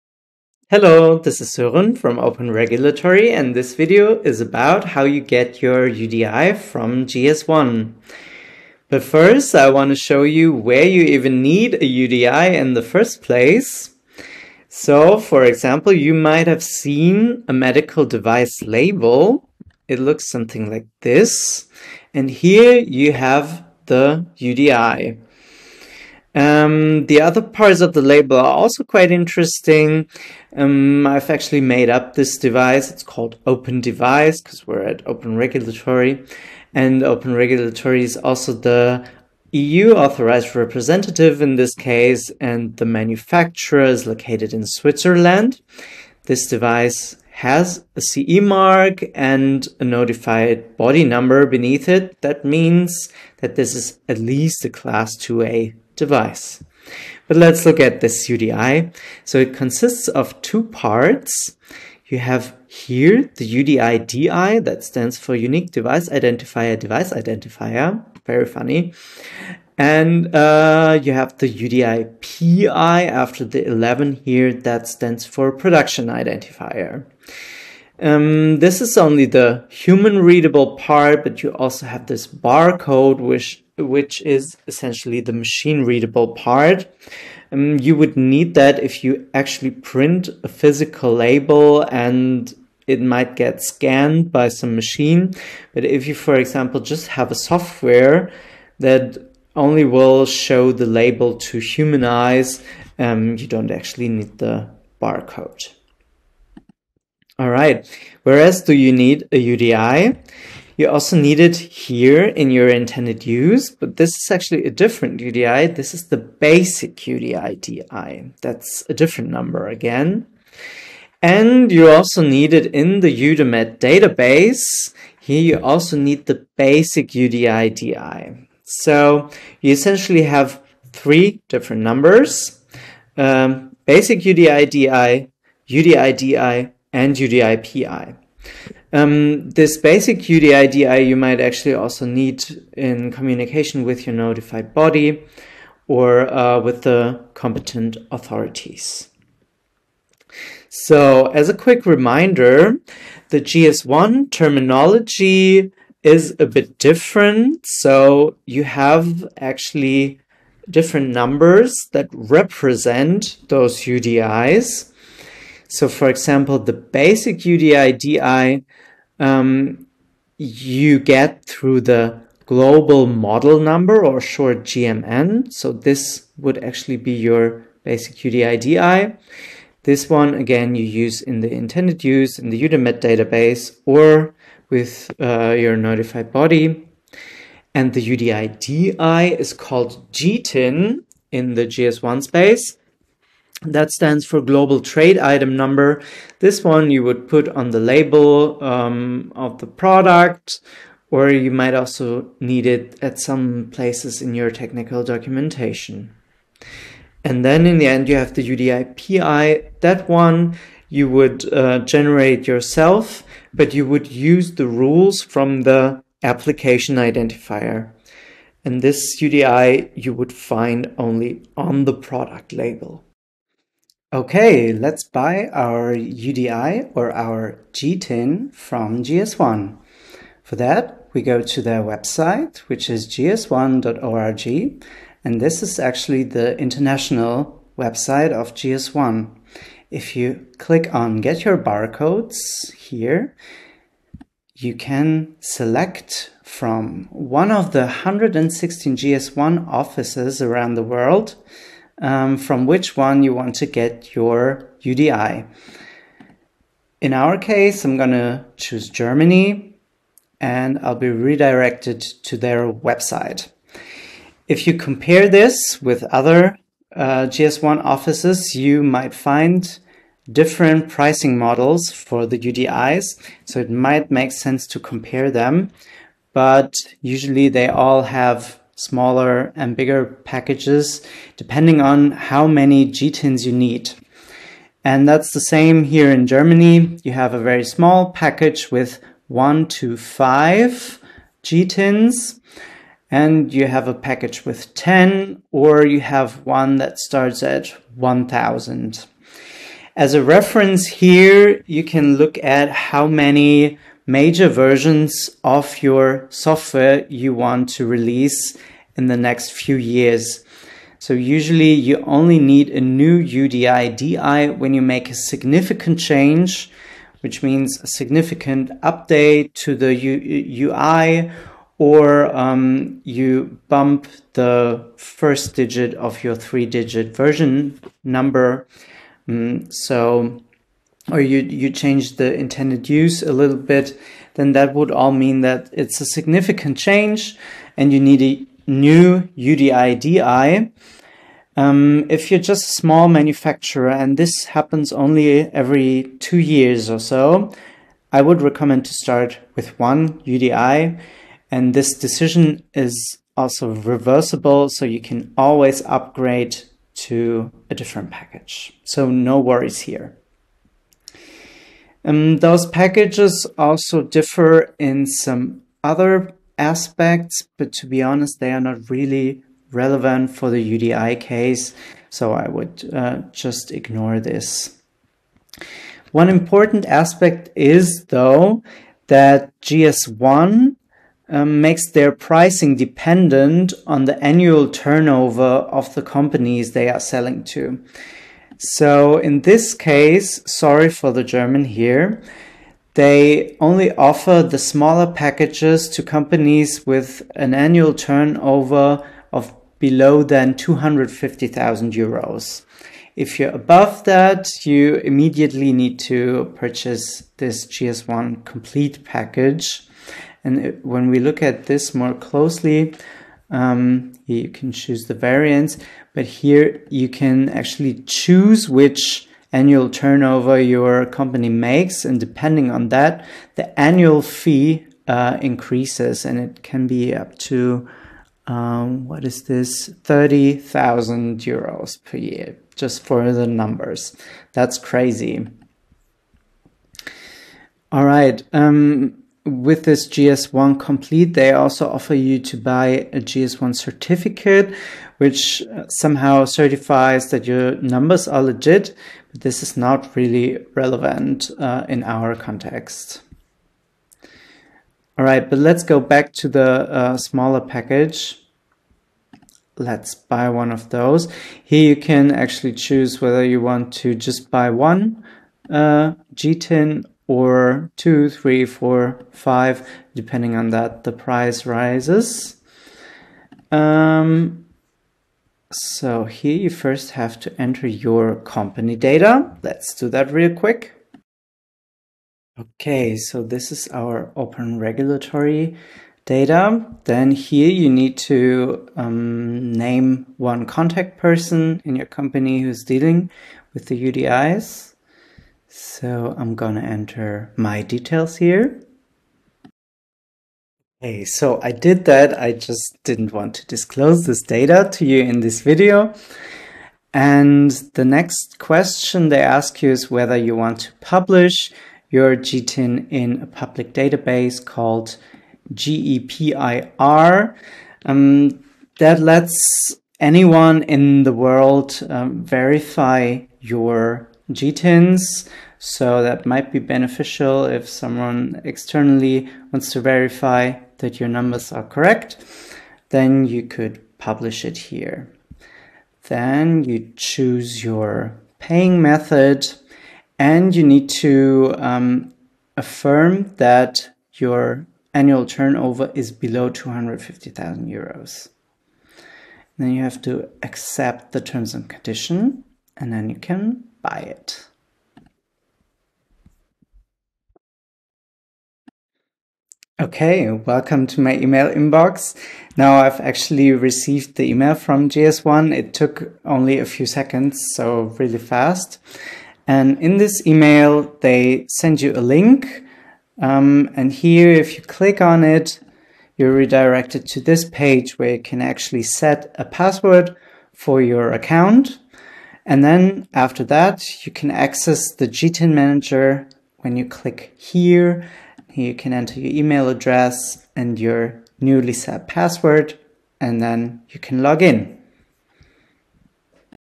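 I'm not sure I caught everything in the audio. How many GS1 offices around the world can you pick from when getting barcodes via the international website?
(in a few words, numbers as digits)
116.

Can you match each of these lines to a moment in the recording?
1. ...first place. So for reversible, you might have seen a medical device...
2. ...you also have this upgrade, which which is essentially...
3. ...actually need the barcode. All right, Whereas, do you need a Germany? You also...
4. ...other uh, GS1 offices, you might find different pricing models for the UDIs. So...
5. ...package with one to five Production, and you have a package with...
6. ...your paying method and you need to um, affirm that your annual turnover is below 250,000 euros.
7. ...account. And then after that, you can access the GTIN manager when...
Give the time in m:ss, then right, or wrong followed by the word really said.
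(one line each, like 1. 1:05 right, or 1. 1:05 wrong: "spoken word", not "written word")
1. 0:12 wrong: "example", not "reversible"
2. 1:21 wrong: "barcode", not "upgrade"
3. 1:43 wrong: "UDI", not "Germany"
4. 4:26 right
5. 4:48 wrong: "GTINs", not "Production"
6. 8:57 right
7. 9:41 right.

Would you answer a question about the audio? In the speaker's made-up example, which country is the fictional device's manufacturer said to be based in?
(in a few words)
Switzerland.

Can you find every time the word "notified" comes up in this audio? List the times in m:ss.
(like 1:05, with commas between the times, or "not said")
0:49, 2:24, 3:05.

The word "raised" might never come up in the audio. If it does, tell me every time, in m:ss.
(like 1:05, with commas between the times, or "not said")
not said.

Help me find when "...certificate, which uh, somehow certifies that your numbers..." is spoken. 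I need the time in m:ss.
7:23.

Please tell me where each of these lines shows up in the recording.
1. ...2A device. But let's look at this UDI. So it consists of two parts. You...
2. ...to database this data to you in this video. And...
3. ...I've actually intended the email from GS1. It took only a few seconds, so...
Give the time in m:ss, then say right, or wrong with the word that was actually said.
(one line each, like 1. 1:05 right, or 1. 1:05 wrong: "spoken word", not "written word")
1. 0:55 right
2. 8:23 wrong: "disclose", not "database"
3. 9:23 wrong: "received", not "intended".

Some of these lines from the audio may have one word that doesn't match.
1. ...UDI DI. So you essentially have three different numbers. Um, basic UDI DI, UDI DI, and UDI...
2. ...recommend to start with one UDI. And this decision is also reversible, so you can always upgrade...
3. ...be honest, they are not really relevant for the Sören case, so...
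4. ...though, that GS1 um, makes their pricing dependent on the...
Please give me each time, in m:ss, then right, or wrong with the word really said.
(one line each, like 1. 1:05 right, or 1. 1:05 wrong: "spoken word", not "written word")
1. 2:07 right
2. 5:48 right
3. 6:07 wrong: "UDI", not "Sören"
4. 6:18 right.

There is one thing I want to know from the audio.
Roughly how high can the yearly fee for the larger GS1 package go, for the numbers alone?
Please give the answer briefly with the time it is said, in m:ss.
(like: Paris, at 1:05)
30,000 euros, at 7:10.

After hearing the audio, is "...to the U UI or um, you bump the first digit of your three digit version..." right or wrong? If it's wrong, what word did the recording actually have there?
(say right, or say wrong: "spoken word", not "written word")
right.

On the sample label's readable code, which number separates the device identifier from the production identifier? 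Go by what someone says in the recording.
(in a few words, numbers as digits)
11.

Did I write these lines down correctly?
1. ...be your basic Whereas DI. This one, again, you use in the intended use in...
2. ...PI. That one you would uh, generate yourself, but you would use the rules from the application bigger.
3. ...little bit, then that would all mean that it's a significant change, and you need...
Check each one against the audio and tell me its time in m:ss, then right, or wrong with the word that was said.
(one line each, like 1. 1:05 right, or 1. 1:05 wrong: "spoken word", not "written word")
1. 2:56 wrong: "UDI", not "Whereas"
2. 3:28 wrong: "identifier", not "bigger"
3. 5:33 right.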